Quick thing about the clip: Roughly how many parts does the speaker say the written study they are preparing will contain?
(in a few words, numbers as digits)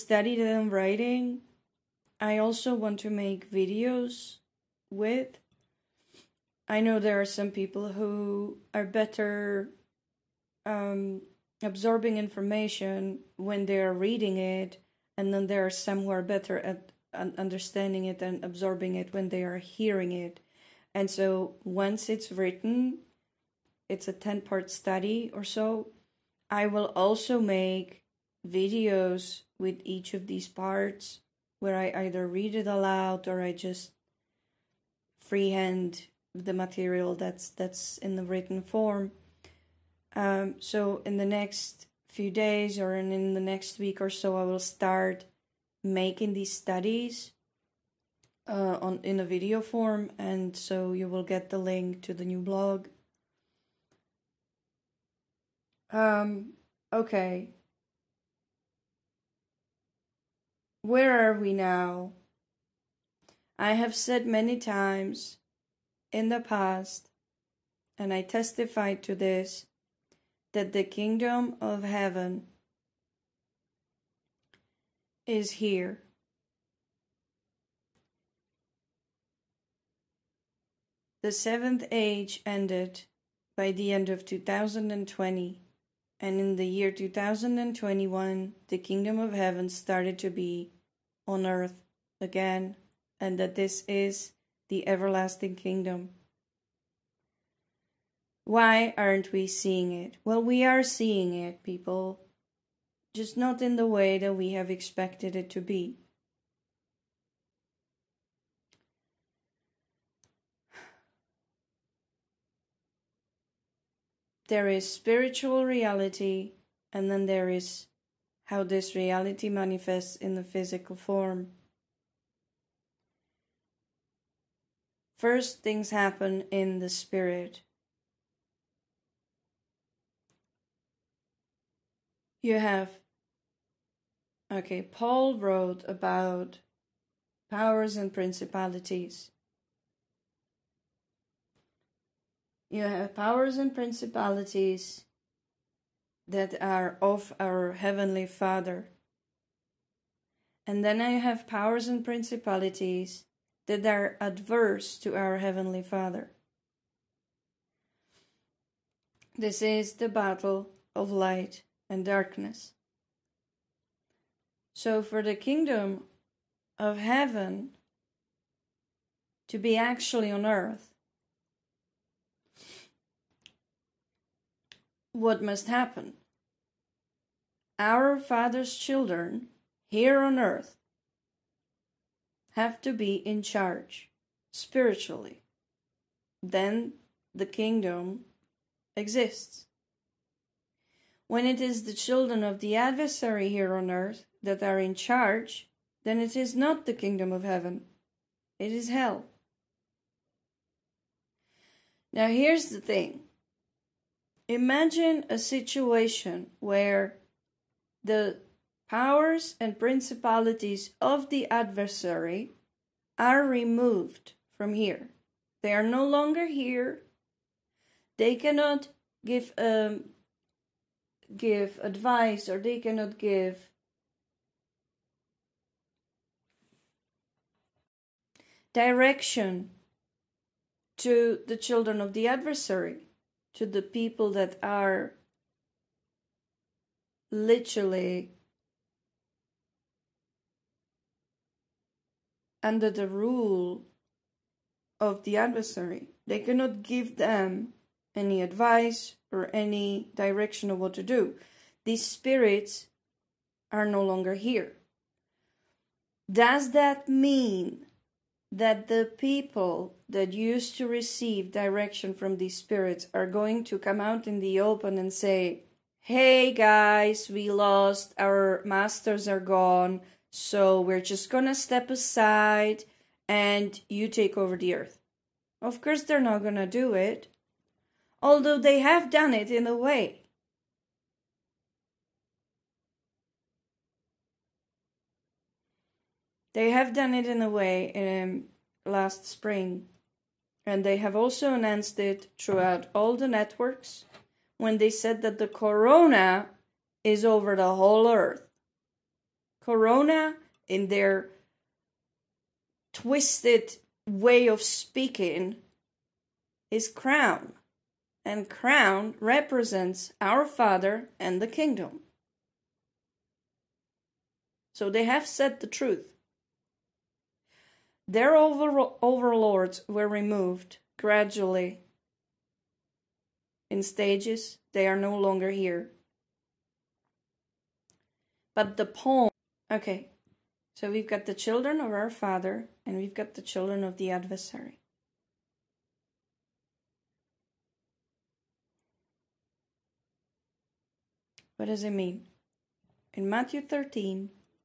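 10.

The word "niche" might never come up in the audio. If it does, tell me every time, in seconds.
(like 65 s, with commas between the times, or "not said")
not said.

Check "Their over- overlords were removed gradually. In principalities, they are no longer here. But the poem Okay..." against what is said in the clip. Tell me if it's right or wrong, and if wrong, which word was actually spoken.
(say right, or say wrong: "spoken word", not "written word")
wrong: "stages", not "principalities".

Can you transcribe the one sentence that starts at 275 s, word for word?
Of course, they're not gonna do it, although they have done it in a way.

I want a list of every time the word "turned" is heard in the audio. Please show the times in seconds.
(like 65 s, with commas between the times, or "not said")
not said.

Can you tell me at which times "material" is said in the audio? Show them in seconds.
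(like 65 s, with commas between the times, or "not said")
36 s.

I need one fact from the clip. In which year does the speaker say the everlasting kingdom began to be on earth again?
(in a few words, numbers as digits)
2021.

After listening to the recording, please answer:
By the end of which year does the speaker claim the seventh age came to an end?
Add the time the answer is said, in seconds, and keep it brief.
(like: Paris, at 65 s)
2020, at 83 s.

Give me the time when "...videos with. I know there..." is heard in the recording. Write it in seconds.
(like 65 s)
3 s.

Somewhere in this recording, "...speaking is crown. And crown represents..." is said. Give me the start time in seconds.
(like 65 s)
304 s.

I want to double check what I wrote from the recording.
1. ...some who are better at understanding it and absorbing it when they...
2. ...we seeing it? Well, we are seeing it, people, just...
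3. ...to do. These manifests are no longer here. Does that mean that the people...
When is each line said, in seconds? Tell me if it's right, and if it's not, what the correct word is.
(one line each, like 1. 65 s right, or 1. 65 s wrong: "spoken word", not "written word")
1. 15 s right
2. 99 s right
3. 250 s wrong: "spirits", not "manifests".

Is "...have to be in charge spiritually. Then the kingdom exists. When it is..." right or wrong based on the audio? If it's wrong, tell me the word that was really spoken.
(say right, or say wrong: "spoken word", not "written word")
right.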